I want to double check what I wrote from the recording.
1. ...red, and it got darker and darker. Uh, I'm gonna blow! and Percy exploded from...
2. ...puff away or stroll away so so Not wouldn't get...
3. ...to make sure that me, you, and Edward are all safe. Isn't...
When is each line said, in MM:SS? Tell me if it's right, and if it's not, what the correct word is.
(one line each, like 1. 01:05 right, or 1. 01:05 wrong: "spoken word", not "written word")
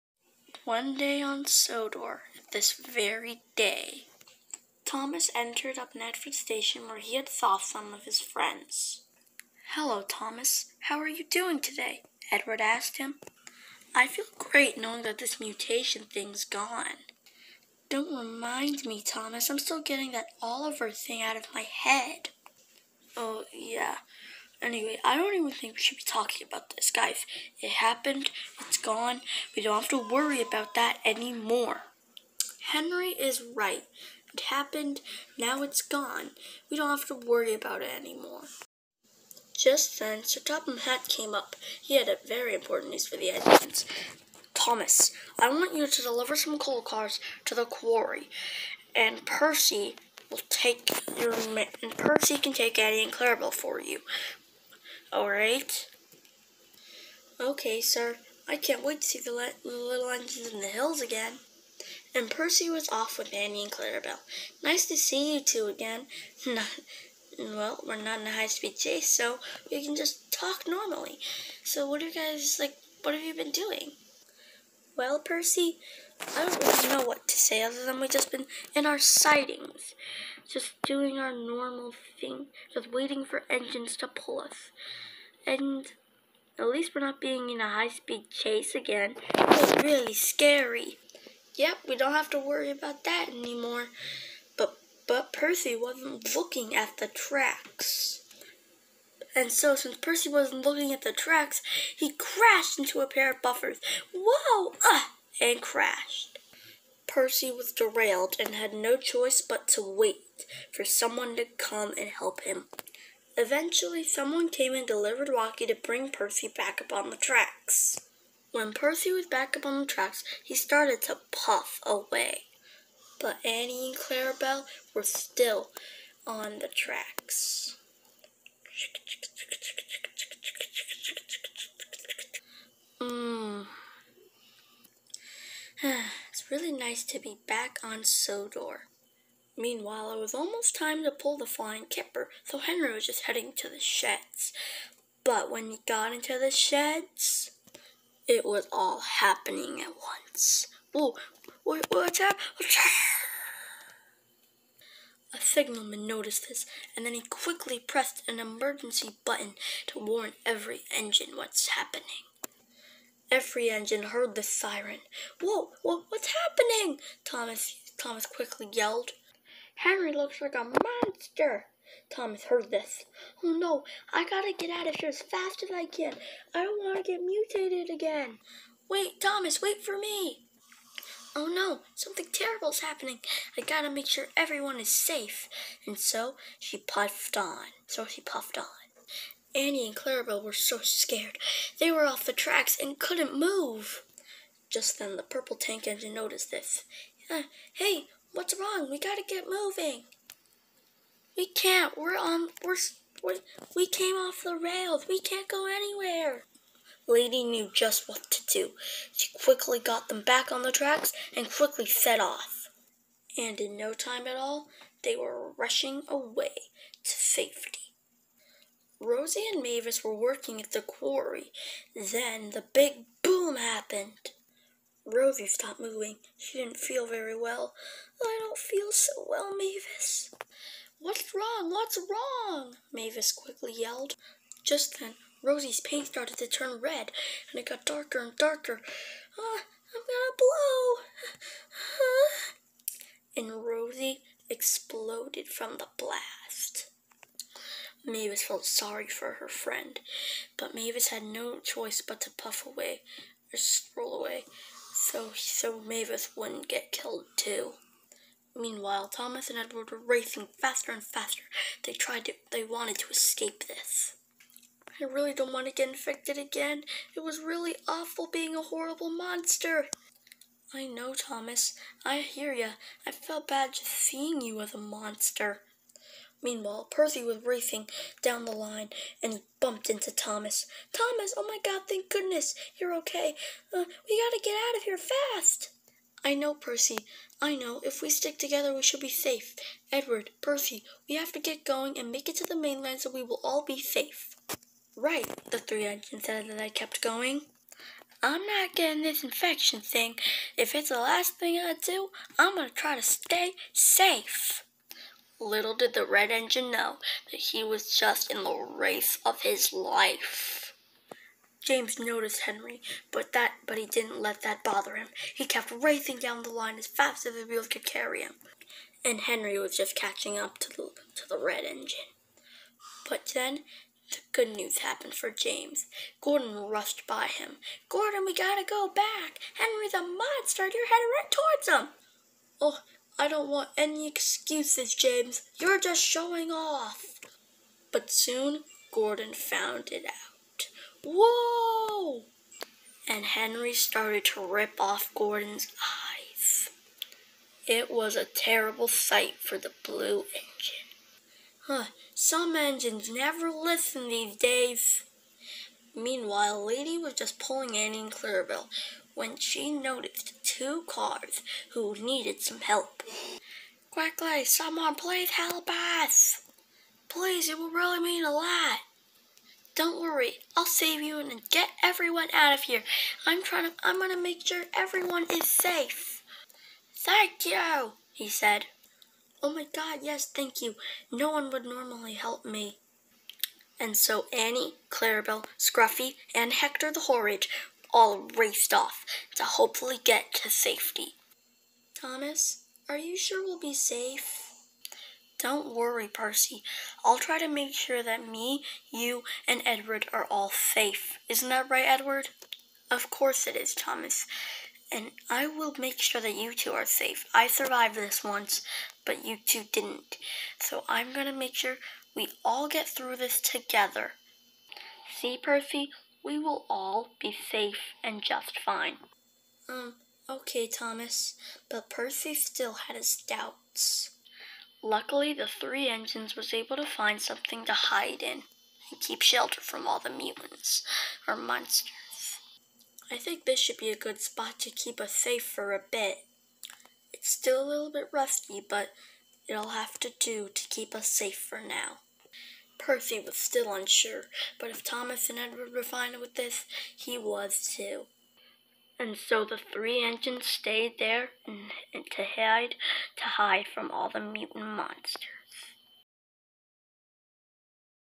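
1. 03:56 wrong: "Rosie", not "Percy"
2. 04:12 wrong: "Mavis", not "Not"
3. 06:37 right.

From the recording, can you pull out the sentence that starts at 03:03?
I gotta make sure everyone is safe.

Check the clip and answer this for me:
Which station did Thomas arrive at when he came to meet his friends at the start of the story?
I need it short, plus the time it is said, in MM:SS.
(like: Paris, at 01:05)
Nedford Station, at 00:05.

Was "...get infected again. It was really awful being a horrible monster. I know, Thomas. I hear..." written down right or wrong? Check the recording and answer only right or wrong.
right.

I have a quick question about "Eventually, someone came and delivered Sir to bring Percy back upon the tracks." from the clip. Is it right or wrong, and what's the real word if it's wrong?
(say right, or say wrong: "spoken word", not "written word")
wrong: "Rocky", not "Sir".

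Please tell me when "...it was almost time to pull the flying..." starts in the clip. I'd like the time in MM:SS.
02:20.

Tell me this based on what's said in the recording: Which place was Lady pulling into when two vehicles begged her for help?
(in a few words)
Clearville.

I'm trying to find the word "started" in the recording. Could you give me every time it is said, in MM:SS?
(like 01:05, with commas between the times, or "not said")
02:00, 03:56, 05:43.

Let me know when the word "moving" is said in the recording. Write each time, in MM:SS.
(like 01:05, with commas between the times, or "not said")
03:19, 03:45.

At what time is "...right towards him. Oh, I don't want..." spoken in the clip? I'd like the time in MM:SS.
05:31.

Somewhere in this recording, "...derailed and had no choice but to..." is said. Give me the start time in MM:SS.
01:47.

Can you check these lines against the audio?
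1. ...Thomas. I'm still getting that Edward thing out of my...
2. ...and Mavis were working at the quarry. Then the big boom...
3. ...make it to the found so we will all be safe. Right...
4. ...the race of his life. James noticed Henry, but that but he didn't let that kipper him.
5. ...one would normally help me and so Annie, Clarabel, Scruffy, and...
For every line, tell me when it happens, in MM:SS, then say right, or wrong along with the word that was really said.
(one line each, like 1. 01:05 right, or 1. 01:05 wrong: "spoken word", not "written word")
1. 00:19 wrong: "Oliver", not "Edward"
2. 03:39 right
3. 04:52 wrong: "mainland", not "found"
4. 05:08 wrong: "bother", not "kipper"
5. 06:21 right.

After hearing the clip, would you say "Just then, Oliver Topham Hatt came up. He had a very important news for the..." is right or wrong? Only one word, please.
wrong.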